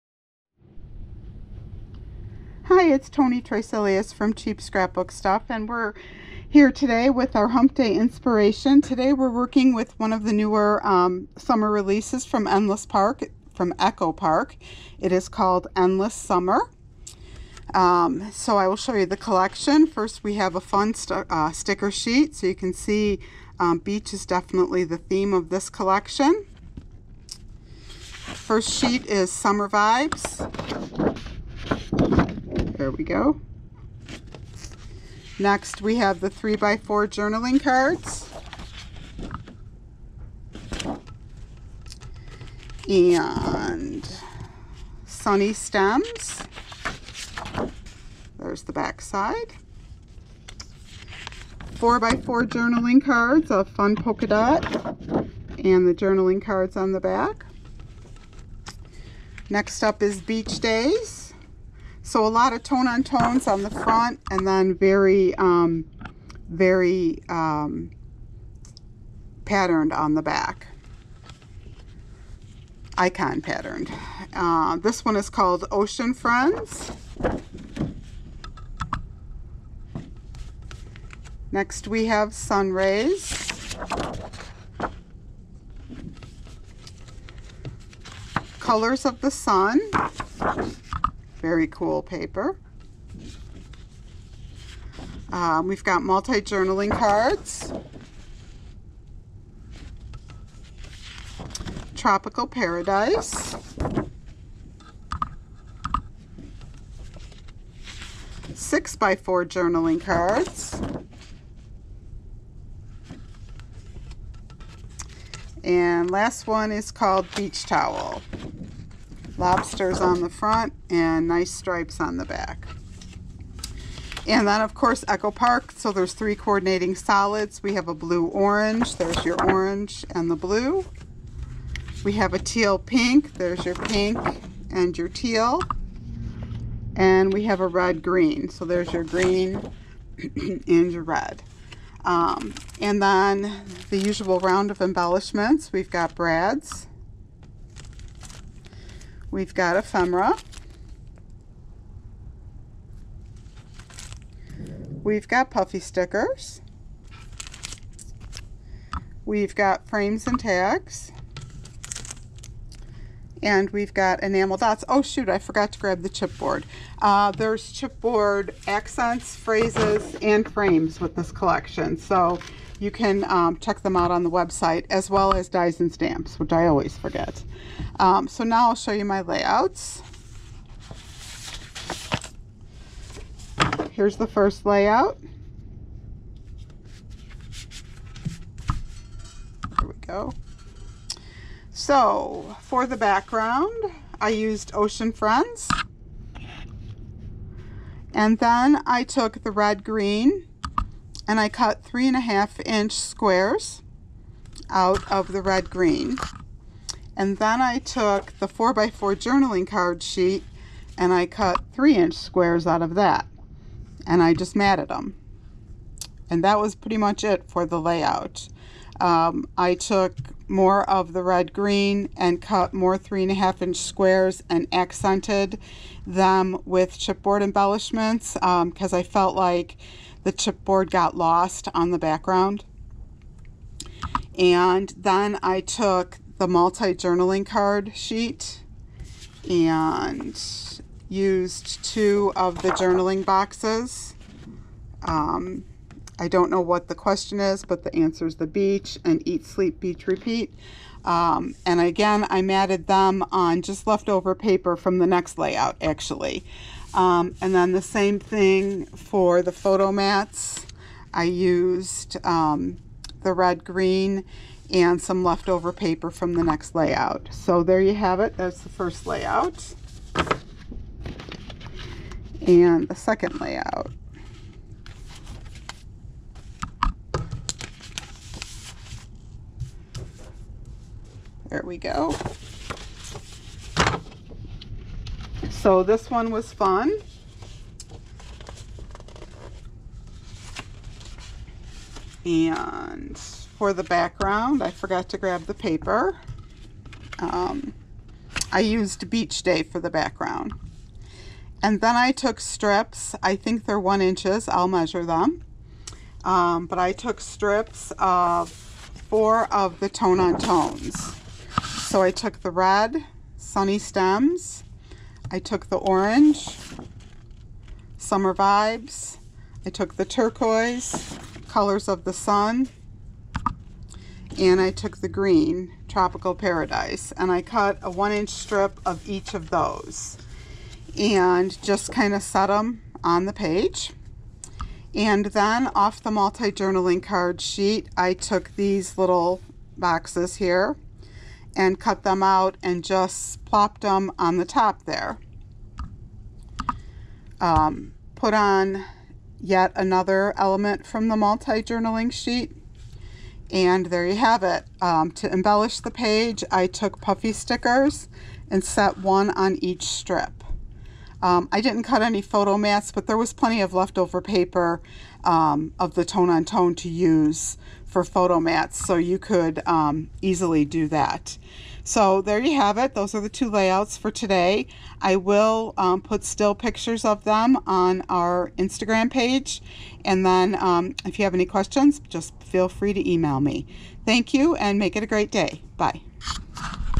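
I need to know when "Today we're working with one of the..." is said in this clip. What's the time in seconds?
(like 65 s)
8 s.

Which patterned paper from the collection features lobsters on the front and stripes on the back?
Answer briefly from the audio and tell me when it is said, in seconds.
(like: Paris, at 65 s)
Beach Towel, at 117 s.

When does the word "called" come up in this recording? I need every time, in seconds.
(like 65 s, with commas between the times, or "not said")
15 s, 75 s, 116 s.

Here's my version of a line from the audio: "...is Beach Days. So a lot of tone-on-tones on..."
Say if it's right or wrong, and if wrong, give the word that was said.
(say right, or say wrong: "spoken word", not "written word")
right.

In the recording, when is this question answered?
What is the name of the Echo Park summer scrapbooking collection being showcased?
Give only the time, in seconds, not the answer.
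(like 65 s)
15 s.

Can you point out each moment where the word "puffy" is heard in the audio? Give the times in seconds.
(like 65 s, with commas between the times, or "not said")
155 s, 357 s.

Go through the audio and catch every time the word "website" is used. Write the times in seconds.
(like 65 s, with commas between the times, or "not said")
174 s.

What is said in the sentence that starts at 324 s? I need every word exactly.
And I took the green, Tropical Paradise.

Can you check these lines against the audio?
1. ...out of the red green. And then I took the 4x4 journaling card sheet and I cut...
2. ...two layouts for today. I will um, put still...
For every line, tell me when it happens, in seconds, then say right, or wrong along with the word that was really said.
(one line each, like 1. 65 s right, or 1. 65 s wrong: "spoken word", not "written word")
1. 204 s right
2. 373 s right.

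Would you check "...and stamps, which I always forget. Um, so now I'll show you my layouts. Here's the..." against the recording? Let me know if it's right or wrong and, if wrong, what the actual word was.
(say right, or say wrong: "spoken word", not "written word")
right.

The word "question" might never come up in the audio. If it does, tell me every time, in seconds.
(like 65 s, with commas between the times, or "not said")
246 s, 381 s.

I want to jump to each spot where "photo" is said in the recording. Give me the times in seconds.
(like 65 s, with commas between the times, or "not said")
259 s, 362 s, 368 s.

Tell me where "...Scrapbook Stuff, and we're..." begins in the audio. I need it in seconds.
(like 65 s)
4 s.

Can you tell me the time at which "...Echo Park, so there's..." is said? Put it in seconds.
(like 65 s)
125 s.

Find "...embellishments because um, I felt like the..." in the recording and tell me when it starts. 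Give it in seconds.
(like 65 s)
227 s.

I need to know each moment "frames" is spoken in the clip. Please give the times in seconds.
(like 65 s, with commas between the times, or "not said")
159 s, 170 s.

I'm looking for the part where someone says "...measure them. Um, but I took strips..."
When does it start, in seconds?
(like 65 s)
304 s.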